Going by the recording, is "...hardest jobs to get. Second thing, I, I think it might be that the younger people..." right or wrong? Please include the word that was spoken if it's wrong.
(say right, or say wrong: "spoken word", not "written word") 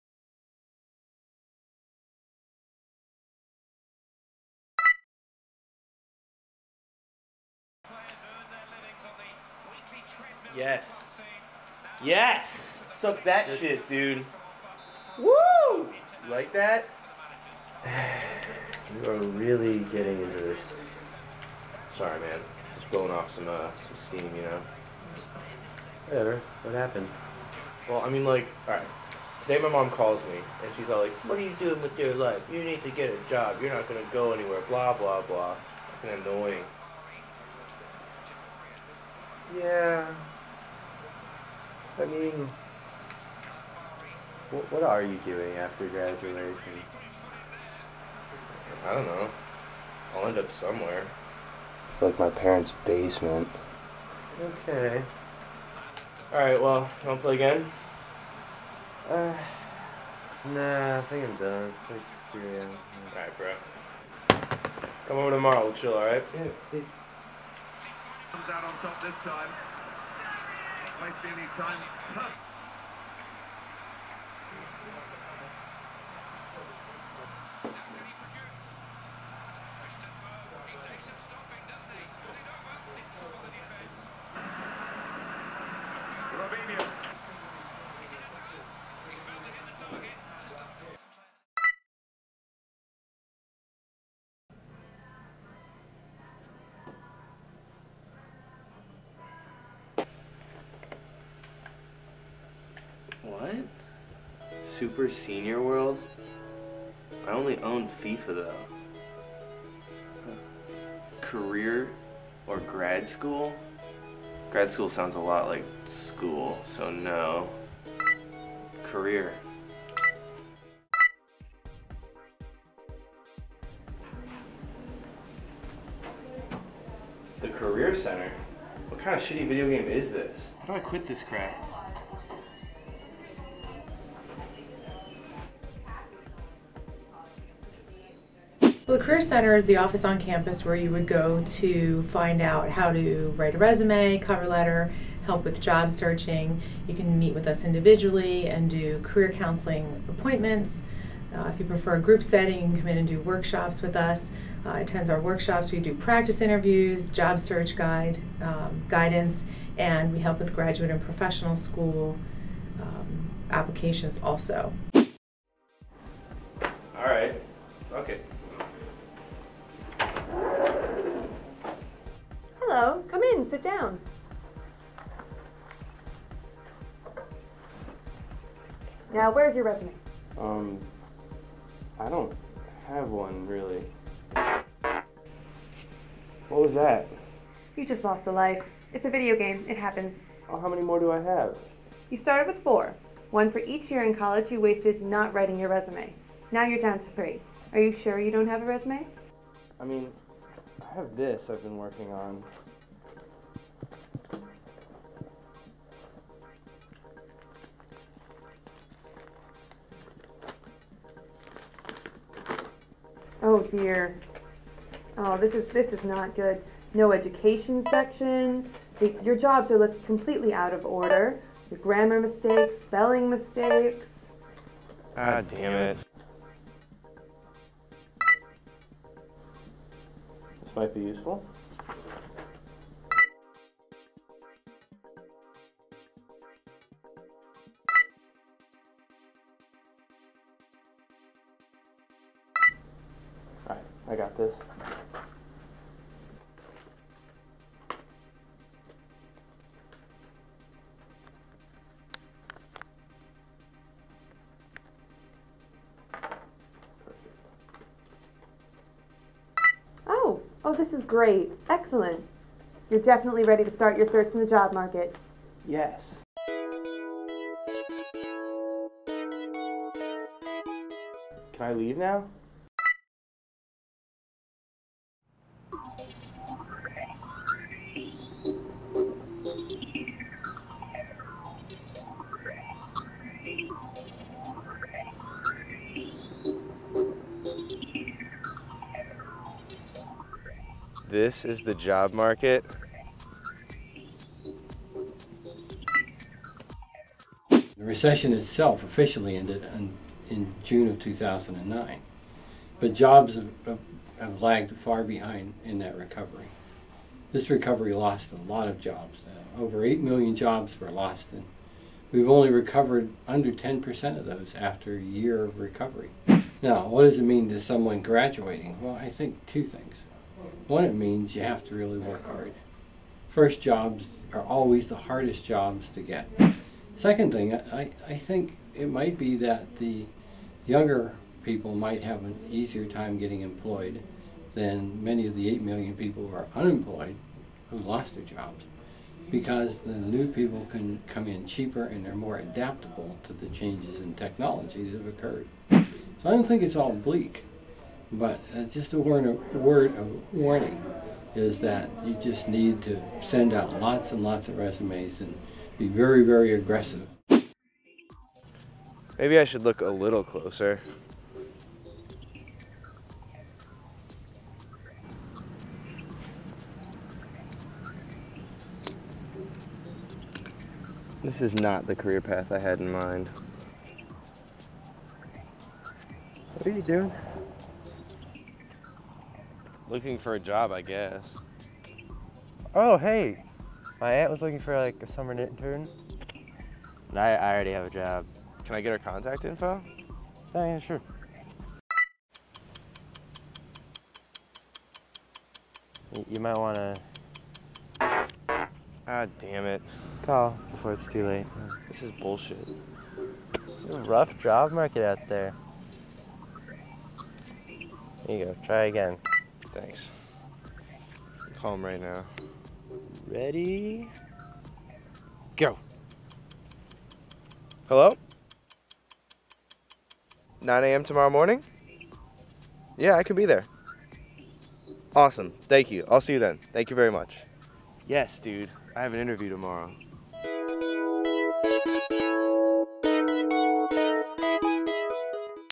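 right.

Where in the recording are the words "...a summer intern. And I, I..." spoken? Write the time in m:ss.
6:25.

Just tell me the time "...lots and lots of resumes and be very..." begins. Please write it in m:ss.
5:53.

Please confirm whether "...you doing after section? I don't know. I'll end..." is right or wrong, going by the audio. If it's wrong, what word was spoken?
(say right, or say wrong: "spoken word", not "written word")
wrong: "graduation", not "section".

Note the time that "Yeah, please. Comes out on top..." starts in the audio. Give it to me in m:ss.
1:06.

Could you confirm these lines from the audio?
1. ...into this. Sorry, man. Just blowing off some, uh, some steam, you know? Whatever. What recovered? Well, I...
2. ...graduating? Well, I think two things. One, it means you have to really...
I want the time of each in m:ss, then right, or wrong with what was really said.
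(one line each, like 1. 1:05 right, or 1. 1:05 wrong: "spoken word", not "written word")
1. 0:20 wrong: "happened", not "recovered"
2. 5:18 right.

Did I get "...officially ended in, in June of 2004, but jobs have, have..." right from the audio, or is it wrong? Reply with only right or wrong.
wrong.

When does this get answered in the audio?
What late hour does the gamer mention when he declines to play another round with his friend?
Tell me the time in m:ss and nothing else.
1:02.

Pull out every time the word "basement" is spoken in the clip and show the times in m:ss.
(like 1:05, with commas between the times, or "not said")
0:52.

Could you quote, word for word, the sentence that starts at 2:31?
Uh, if you prefer a group setting, you can come in and do workshops with us.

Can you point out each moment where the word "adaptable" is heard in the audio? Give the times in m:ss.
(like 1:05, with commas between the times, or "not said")
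5:42.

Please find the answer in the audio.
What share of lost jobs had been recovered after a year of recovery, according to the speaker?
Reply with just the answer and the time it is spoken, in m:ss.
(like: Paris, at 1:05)
under 10%, at 5:13.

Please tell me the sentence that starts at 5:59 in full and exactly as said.
Maybe I should look a little closer.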